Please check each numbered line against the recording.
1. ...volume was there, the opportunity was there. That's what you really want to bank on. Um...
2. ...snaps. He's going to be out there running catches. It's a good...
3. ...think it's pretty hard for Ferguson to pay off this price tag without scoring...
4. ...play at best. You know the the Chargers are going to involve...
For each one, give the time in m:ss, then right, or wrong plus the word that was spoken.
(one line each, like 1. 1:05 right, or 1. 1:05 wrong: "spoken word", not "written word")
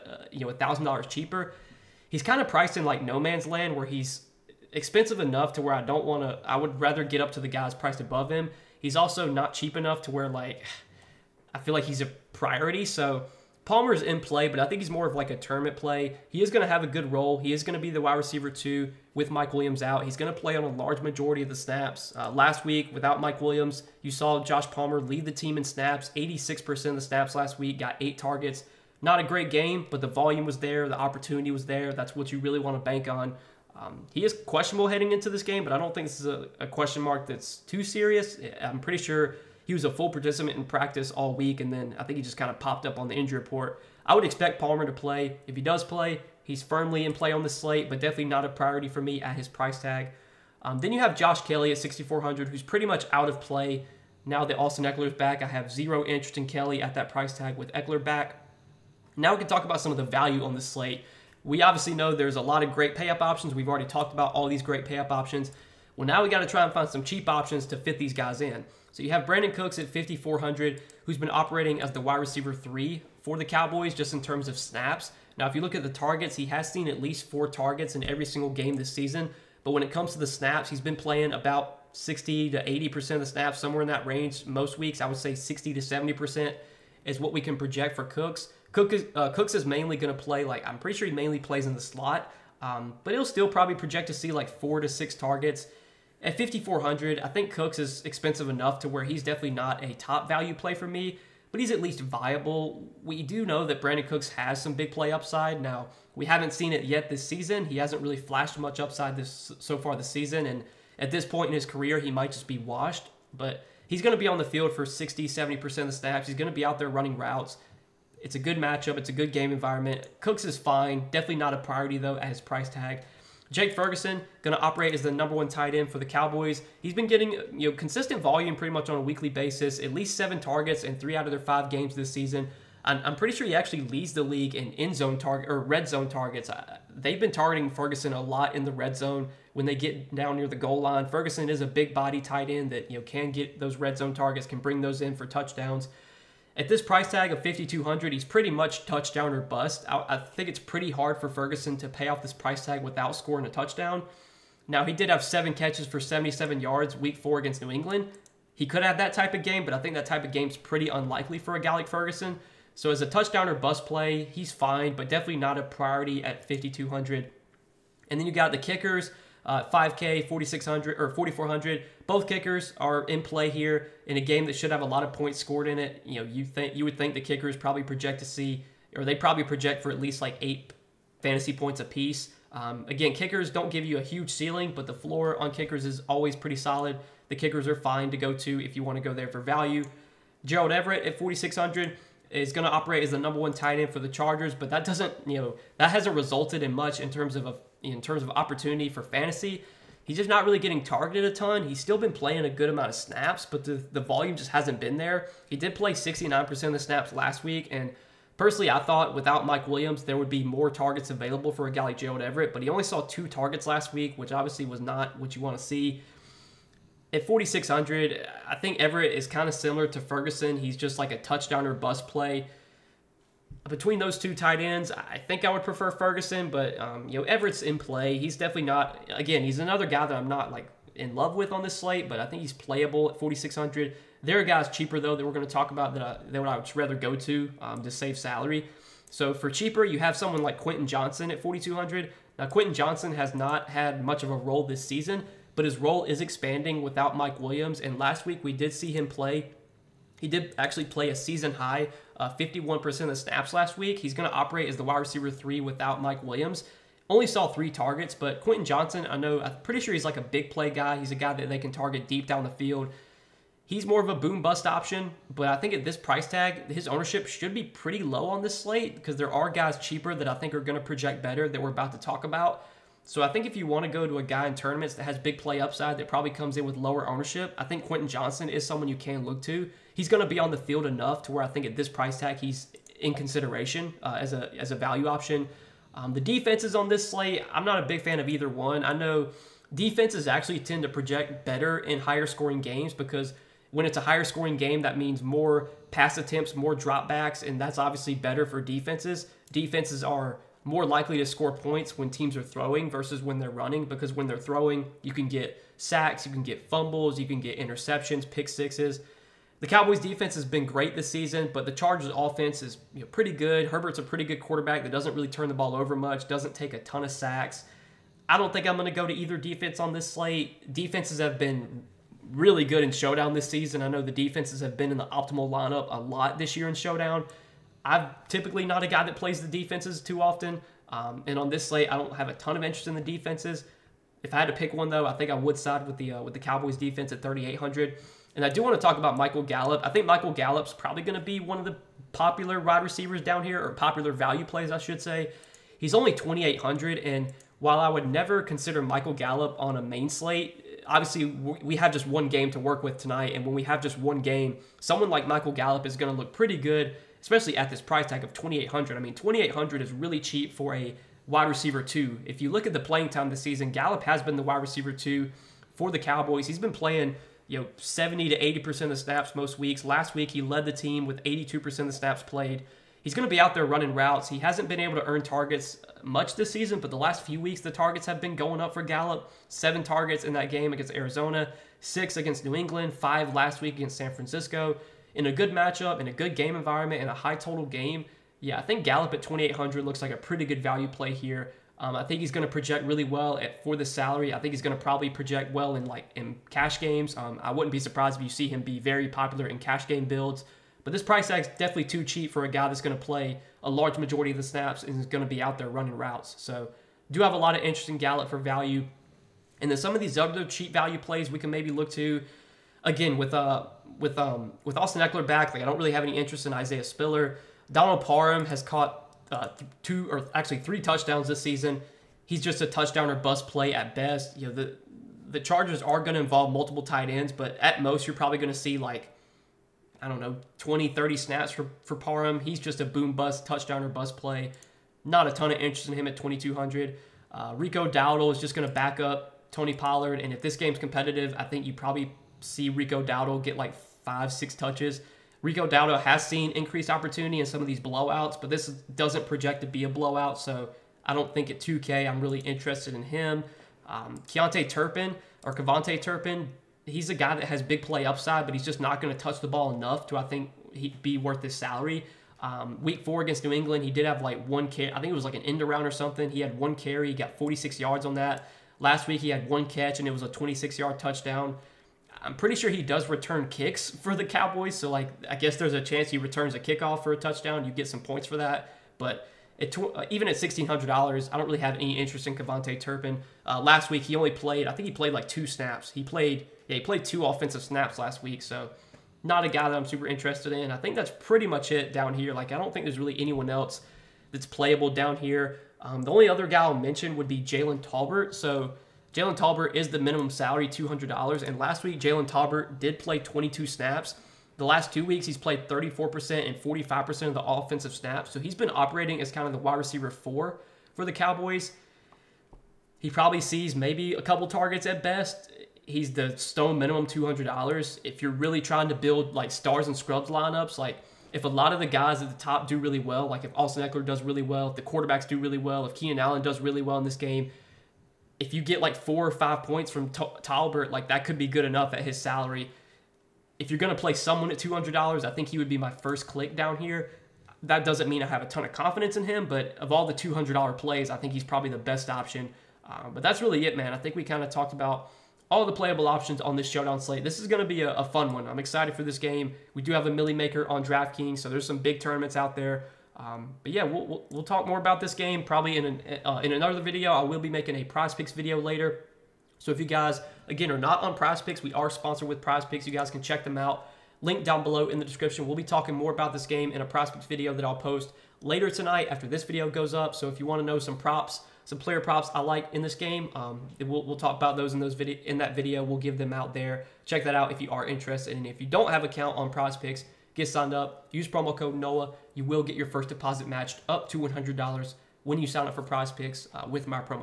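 1. 0:30 right
2. 1:55 wrong: "routes", not "catches"
3. 2:30 right
4. 7:03 right.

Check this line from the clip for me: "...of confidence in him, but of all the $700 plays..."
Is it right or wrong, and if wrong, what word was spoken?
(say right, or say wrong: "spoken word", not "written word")
wrong: "200", not "700".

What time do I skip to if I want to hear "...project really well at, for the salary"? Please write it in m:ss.
6:32.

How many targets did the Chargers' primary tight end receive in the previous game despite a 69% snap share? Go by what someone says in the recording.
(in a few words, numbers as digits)
2.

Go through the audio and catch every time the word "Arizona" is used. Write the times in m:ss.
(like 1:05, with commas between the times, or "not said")
6:20.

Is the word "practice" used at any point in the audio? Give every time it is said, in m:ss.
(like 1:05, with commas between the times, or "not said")
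0:40.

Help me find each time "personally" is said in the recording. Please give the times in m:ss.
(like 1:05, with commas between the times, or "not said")
3:28.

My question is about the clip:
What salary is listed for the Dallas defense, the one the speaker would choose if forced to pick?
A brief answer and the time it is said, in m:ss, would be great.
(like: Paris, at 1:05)
3,800, at 5:37.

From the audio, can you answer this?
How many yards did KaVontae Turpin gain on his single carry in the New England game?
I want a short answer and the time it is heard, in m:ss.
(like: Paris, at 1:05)
46, at 7:47.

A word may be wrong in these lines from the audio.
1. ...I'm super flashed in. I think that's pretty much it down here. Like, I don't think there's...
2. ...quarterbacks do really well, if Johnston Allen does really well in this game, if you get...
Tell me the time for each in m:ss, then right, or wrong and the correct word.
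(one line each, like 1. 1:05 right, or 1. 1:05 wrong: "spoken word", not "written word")
1. 8:09 wrong: "interested", not "flashed"
2. 8:44 wrong: "Keenan", not "Johnston".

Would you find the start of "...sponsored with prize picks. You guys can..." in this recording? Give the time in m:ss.
9:21.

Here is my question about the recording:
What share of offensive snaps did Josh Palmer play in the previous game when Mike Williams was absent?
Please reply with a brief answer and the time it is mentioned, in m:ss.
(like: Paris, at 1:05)
86%, at 0:26.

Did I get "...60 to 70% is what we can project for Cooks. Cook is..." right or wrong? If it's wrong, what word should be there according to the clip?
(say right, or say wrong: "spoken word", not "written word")
right.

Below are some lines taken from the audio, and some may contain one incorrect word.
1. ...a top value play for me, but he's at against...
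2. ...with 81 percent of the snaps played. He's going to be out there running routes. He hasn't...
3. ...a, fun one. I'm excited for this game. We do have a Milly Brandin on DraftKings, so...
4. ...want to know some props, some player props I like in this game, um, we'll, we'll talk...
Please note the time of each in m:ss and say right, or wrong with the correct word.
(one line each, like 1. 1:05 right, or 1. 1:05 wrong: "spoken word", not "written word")
1. 1:39 wrong: "least", not "against"
2. 6:11 wrong: "82", not "81"
3. 9:07 wrong: "Maker", not "Brandin"
4. 9:30 right.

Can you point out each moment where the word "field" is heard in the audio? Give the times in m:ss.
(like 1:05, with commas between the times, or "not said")
1:54, 4:22, 4:40.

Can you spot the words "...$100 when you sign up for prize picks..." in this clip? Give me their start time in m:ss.
9:44.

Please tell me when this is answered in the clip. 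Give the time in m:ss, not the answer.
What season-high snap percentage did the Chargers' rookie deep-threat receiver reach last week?
4:12.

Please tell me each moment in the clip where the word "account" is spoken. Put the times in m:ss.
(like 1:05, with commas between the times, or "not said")
9:39.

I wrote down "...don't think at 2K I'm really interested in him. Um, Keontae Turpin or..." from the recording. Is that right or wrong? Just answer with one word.
right.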